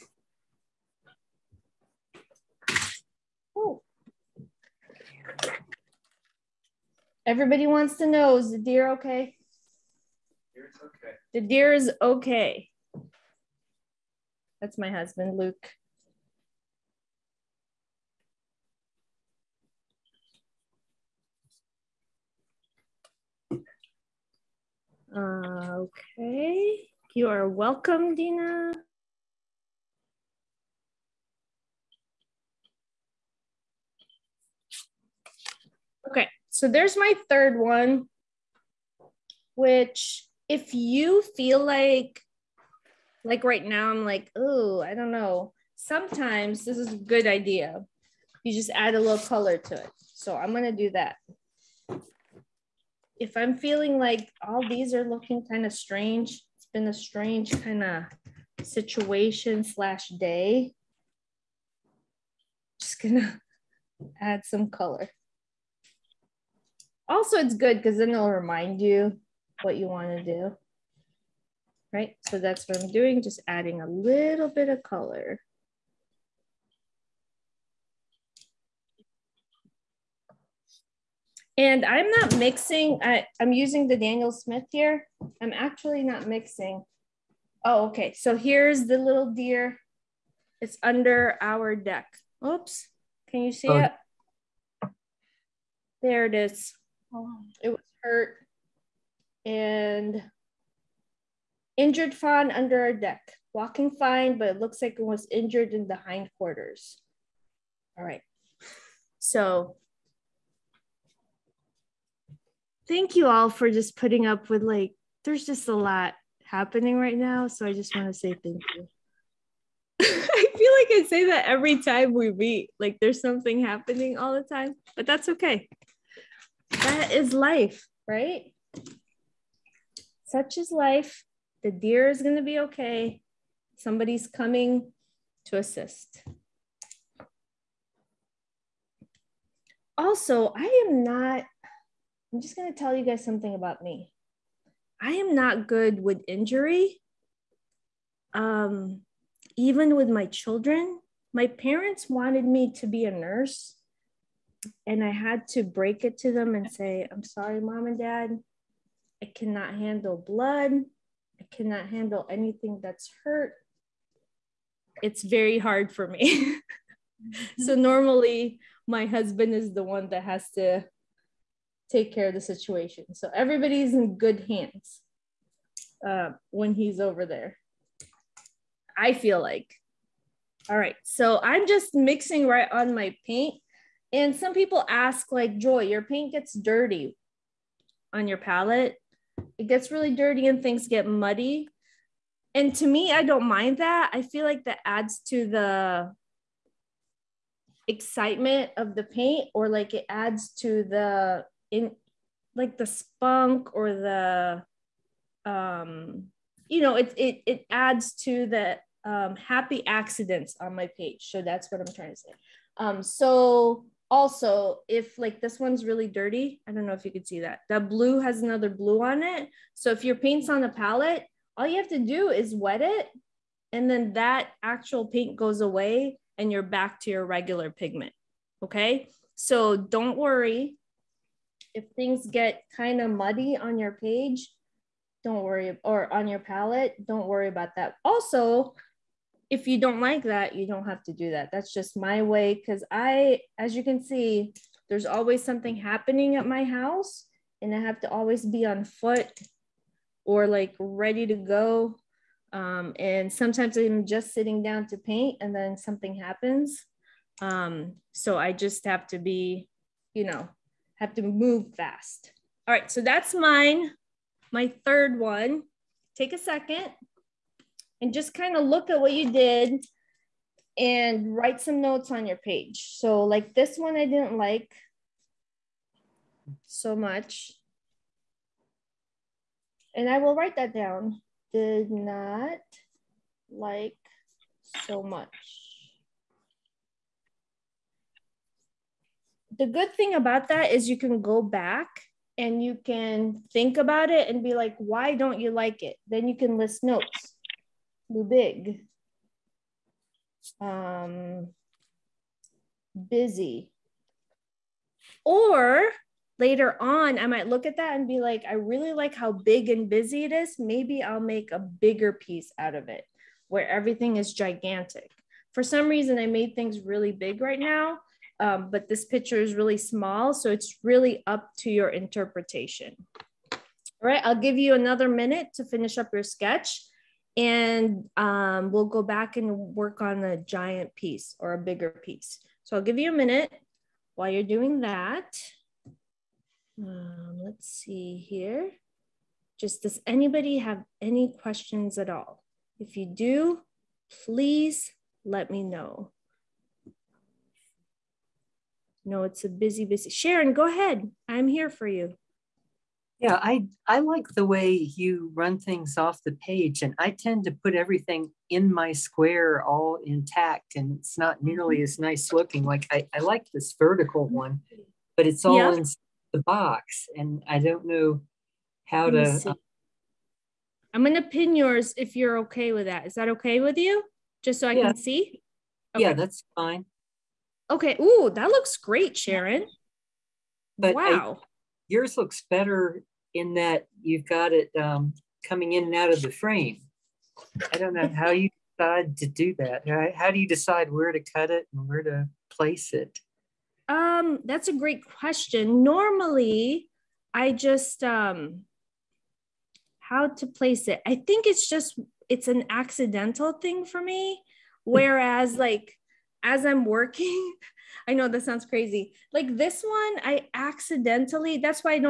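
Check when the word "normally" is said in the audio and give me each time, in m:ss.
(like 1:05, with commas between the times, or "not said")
2:47, 6:35.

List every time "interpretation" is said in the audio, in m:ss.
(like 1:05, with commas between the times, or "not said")
5:21.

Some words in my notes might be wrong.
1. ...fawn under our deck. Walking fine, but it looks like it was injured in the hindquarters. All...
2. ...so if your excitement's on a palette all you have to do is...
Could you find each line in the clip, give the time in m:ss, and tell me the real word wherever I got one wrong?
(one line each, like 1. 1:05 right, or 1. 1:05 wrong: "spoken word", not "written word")
1. 1:42 right
2. 3:39 wrong: "paint", not "excitement".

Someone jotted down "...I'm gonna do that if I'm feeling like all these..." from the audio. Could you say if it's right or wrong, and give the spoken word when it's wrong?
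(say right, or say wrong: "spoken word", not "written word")
right.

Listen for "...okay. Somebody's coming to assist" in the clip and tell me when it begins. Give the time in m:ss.
2:12.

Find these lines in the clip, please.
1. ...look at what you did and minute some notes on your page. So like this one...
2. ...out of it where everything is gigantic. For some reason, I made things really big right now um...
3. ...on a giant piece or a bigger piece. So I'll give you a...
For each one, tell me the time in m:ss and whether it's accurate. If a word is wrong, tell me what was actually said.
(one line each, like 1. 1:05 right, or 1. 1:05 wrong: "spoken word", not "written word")
1. 4:28 wrong: "write", not "minute"
2. 5:12 right
3. 5:30 right.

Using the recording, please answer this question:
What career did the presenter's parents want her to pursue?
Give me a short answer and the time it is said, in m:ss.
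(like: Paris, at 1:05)
Nurse, at 2:33.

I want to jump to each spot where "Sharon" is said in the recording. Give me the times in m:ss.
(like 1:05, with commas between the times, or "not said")
5:50, 6:19.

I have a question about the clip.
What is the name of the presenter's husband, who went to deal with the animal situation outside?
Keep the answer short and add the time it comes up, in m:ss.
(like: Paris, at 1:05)
Luke, at 0:15.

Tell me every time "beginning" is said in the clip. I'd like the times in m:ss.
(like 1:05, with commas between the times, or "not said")
not said.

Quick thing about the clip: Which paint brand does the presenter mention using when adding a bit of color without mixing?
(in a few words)
Daniel Smith.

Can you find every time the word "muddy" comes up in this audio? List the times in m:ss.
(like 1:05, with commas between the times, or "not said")
3:11, 3:53.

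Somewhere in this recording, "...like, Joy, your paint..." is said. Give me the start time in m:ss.
3:05.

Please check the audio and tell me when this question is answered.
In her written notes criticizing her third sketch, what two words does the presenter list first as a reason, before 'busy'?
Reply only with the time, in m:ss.
4:58.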